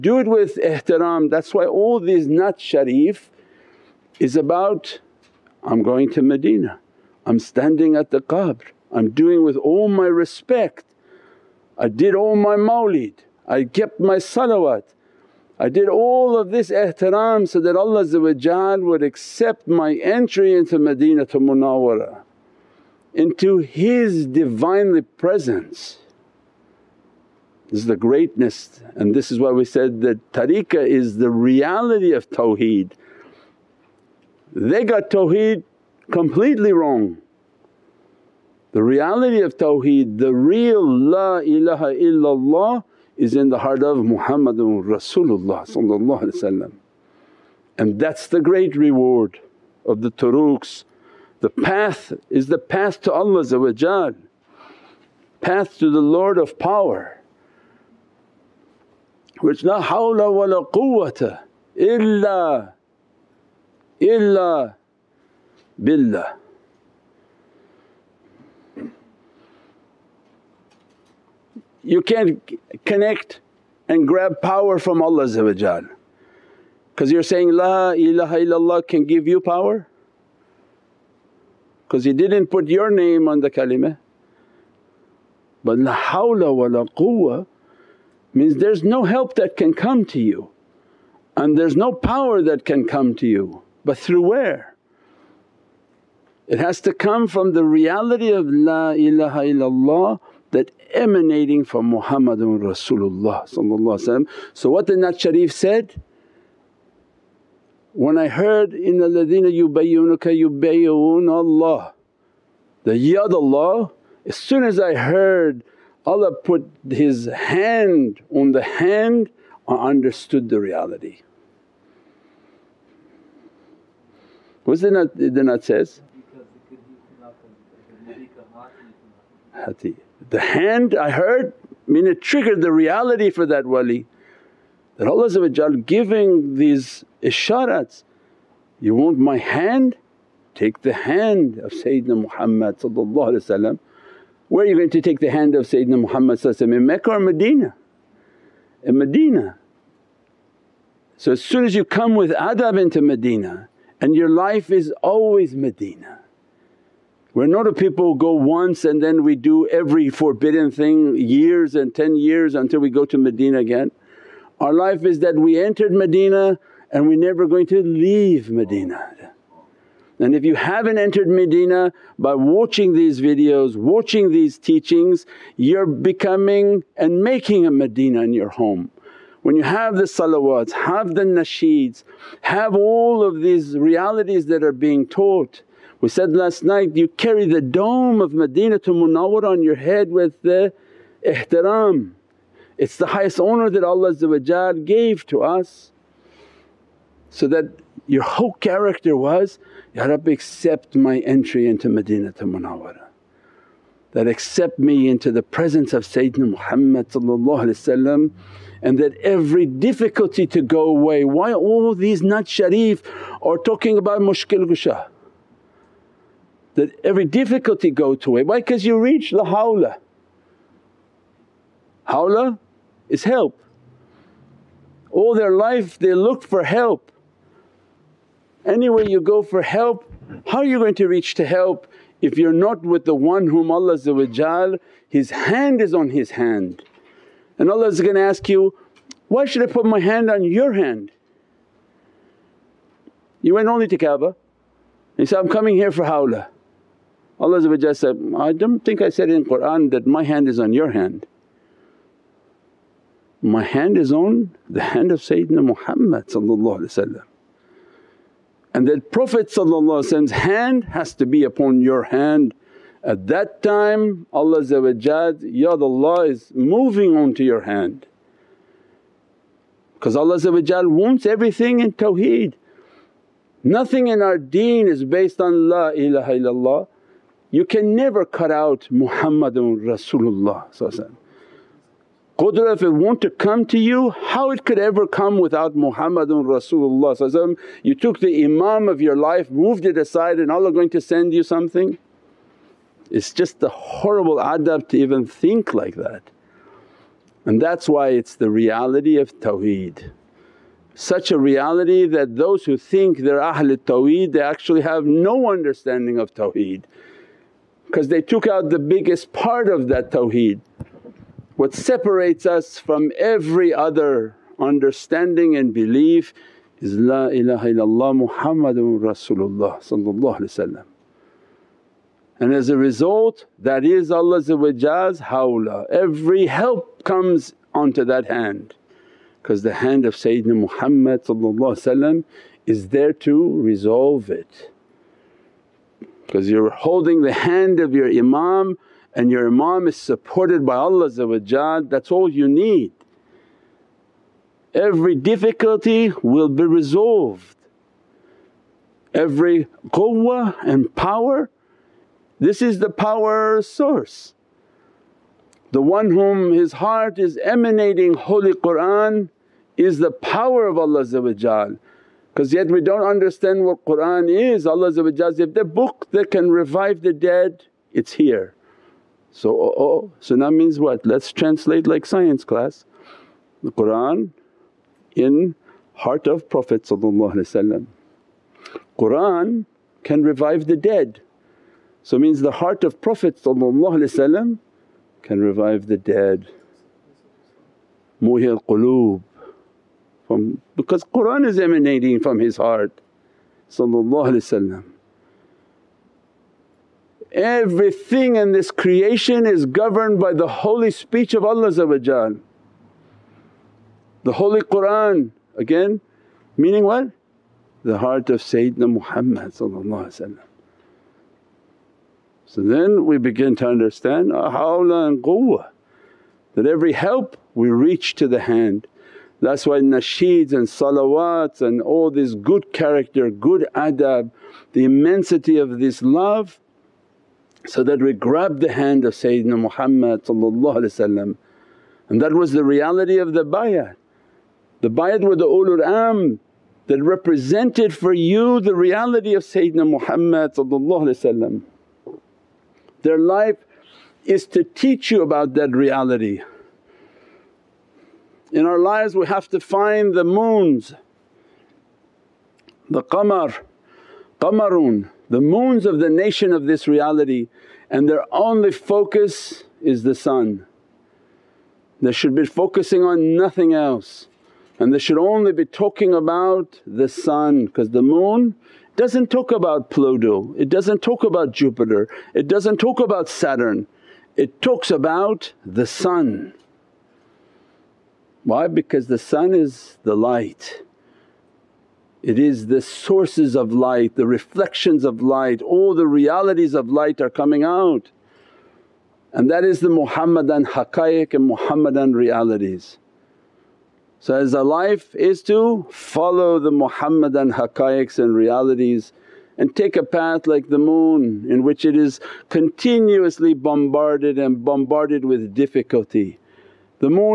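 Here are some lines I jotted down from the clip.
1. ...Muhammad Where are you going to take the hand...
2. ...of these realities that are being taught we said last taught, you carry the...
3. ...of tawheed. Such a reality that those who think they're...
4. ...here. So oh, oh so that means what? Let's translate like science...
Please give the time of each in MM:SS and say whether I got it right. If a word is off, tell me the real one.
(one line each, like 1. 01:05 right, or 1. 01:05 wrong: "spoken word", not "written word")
1. 02:22 right
2. 03:03 wrong: "night", not "taught"
3. 04:59 right
4. 06:08 right.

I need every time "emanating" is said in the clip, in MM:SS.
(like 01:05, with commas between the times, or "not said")
01:40, 05:57, 06:31.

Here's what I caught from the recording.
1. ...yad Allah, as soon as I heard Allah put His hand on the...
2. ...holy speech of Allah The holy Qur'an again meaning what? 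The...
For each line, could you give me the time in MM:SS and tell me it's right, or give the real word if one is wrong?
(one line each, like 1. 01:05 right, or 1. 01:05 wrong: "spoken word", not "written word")
1. 01:52 right
2. 06:40 right.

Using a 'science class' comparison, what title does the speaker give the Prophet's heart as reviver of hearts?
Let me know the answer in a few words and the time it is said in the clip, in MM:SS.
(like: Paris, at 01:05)
Muhi al-qulub, at 06:28.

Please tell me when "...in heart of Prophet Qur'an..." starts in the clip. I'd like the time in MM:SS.
06:15.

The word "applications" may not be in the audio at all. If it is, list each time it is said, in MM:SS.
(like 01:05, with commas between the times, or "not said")
not said.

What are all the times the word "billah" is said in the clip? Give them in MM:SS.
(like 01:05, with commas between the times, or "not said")
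01:05.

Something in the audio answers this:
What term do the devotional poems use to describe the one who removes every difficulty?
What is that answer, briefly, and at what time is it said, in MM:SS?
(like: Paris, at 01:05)
Mushkil gushah, at 03:34.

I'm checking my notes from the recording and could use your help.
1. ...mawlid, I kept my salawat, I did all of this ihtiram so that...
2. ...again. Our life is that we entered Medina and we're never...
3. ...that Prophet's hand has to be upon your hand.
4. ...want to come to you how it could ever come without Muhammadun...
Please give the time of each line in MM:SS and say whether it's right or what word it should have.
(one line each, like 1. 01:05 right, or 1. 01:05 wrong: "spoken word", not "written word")
1. 00:12 right
2. 02:43 right
3. 04:18 right
4. 04:42 right.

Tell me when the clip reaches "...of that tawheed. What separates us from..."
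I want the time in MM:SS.
05:09.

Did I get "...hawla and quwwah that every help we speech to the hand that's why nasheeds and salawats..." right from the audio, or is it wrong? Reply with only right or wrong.
wrong.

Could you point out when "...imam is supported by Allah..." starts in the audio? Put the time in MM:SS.
05:39.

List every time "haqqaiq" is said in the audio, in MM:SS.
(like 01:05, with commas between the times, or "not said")
08:10, 08:17.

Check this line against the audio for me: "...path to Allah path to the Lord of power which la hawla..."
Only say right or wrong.
right.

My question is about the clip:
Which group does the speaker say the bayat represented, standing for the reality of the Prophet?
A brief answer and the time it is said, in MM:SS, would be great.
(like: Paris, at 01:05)
Ulul amr, at 07:15.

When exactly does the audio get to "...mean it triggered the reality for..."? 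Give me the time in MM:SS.
02:11.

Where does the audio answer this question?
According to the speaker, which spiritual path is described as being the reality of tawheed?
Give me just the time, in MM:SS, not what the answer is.
00:30.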